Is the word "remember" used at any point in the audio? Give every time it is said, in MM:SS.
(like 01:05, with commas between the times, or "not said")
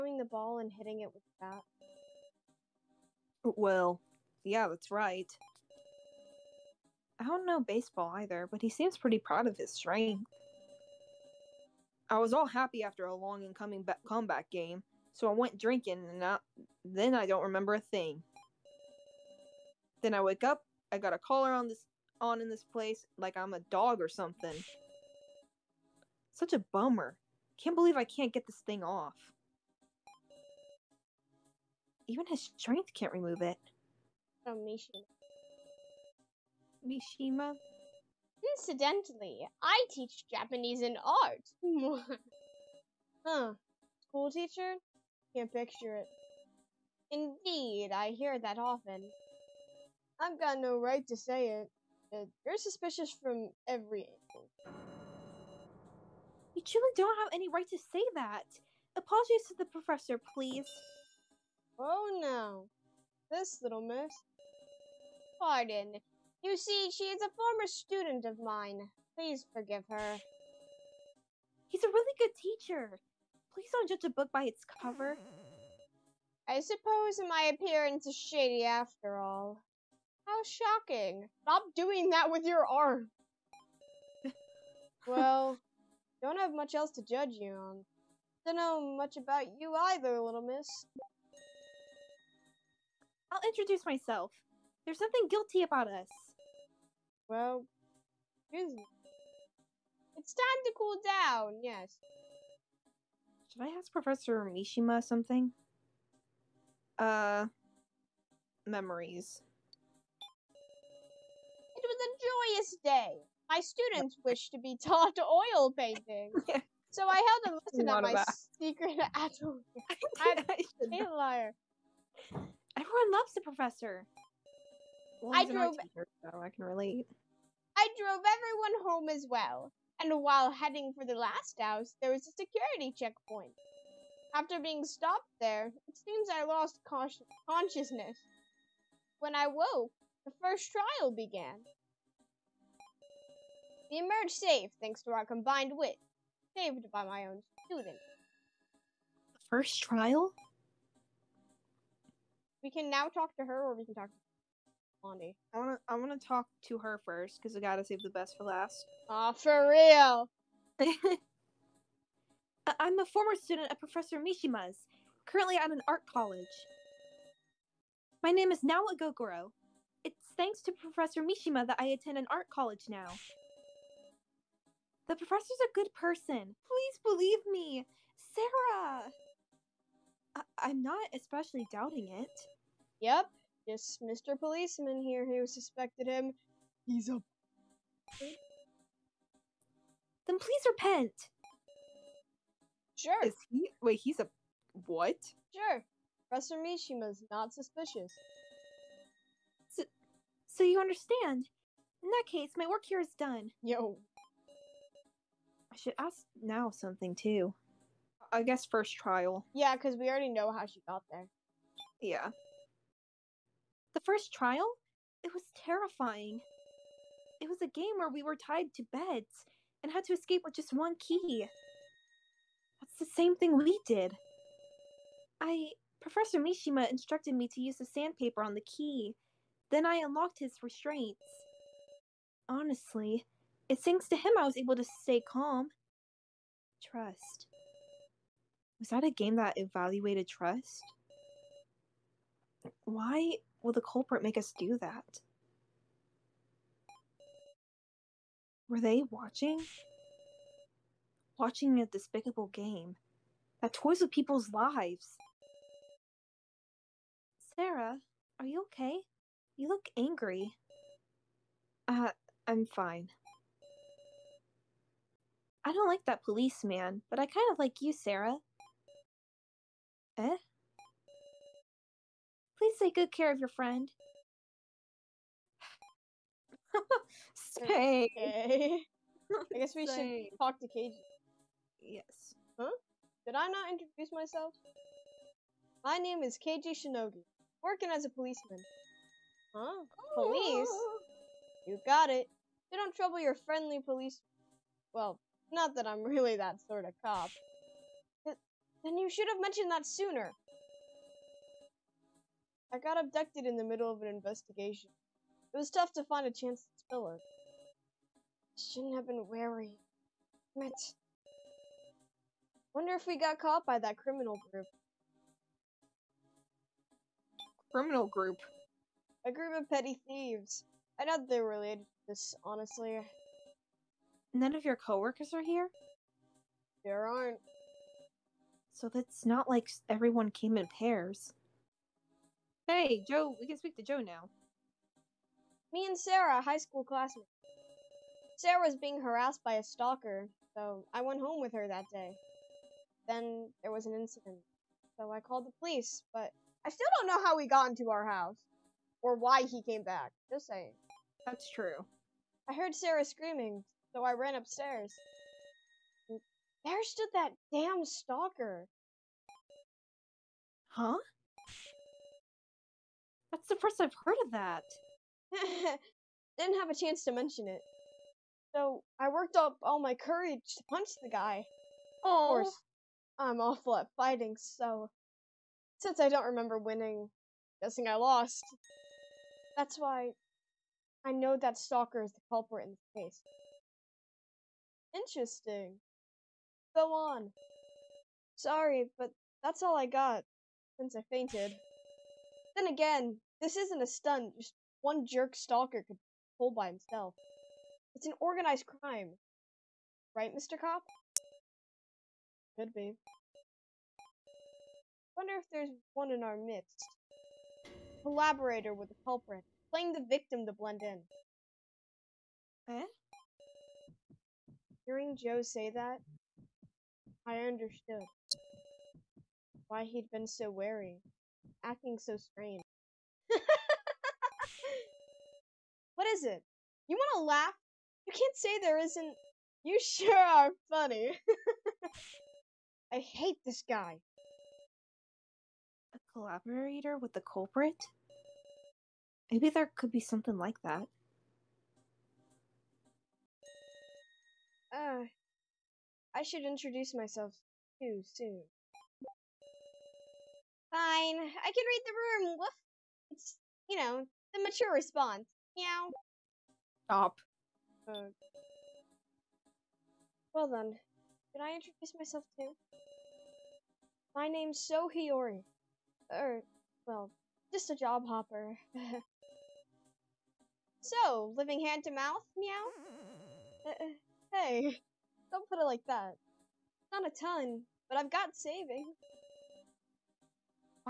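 00:17, 06:16.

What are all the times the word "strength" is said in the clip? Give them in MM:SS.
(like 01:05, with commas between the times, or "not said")
00:09, 00:32.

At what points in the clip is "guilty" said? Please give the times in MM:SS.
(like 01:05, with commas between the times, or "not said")
01:35.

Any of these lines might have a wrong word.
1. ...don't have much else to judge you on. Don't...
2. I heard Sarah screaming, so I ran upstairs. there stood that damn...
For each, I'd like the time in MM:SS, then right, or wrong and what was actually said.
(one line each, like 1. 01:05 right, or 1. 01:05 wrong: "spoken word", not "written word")
1. 01:26 right
2. 05:52 right.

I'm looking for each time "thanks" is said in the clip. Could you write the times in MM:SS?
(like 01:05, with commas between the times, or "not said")
02:24, 02:50, 03:53.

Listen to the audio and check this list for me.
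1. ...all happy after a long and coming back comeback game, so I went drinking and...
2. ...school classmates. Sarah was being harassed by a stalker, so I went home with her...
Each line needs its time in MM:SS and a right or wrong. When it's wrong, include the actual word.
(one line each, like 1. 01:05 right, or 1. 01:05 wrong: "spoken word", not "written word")
1. 00:12 right
2. 05:36 right.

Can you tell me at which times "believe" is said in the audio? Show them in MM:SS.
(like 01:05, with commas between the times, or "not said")
00:27, 02:57.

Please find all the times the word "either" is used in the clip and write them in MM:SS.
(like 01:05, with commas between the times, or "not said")
00:08, 01:29.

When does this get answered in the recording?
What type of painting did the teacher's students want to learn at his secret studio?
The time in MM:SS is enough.
01:55.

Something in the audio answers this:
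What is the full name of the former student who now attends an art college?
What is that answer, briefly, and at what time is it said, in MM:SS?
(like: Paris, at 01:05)
Nao Egokoro, at 02:48.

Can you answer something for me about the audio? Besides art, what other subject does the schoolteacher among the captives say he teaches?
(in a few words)
Japanese.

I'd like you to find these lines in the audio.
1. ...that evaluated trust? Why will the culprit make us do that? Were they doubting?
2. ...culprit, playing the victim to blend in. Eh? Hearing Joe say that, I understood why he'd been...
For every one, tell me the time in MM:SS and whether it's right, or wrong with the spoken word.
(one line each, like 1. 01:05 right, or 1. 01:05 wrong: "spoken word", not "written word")
1. 03:59 wrong: "watching", not "doubting"
2. 06:49 right.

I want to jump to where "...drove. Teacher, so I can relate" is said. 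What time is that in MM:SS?
02:05.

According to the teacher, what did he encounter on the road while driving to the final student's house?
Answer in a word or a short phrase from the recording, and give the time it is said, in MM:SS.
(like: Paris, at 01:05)
a security checkpoint, at 02:12.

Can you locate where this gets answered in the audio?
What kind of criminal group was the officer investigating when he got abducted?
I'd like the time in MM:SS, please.
05:19.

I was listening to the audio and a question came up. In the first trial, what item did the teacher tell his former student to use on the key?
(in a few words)
sandpaper.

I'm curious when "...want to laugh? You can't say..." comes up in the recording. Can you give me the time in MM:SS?
07:06.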